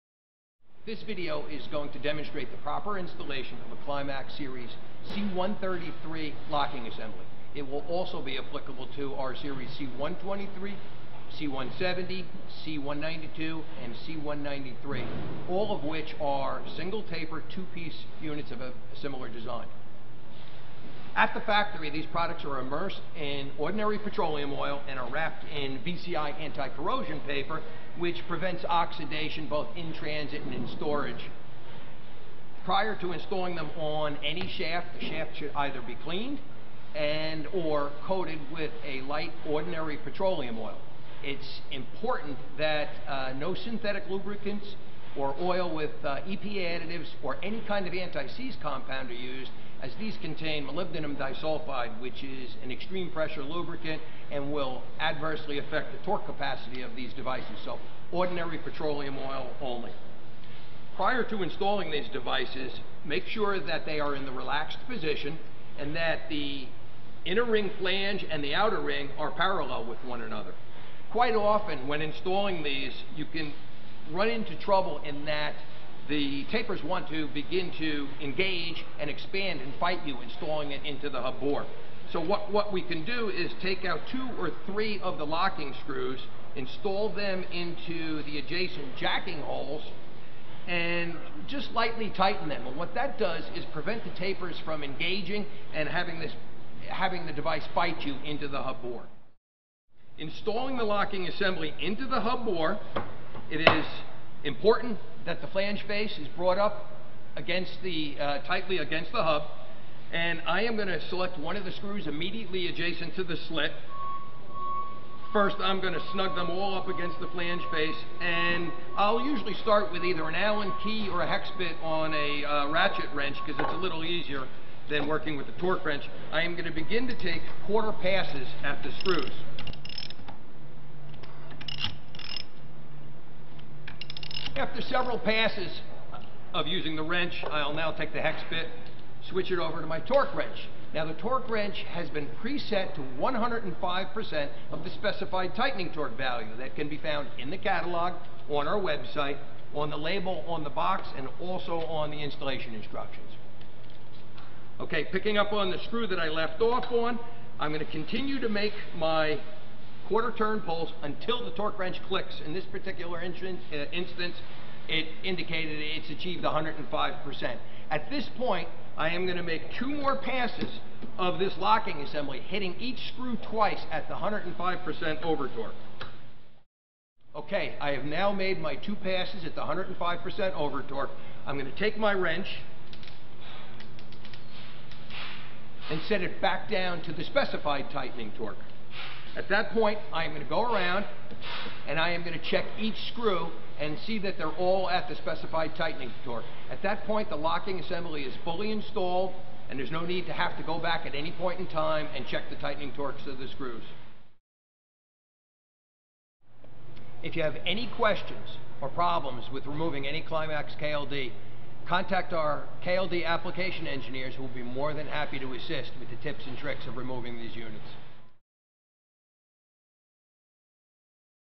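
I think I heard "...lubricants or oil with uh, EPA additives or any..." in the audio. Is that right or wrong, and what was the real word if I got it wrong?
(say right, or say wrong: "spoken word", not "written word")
right.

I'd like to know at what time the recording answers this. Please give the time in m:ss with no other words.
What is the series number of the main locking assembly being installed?
0:05.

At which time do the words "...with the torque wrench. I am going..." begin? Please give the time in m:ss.
2:05.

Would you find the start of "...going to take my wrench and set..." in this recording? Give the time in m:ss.
3:01.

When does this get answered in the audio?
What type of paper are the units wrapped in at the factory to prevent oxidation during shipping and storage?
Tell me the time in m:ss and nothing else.
0:25.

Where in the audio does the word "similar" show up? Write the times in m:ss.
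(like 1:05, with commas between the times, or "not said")
0:18.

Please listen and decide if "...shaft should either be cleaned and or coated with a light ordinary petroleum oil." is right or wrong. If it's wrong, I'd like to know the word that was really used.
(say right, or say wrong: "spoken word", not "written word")
right.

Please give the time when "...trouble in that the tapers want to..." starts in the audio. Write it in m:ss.
1:14.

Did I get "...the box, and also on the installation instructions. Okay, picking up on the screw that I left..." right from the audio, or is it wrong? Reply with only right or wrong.
right.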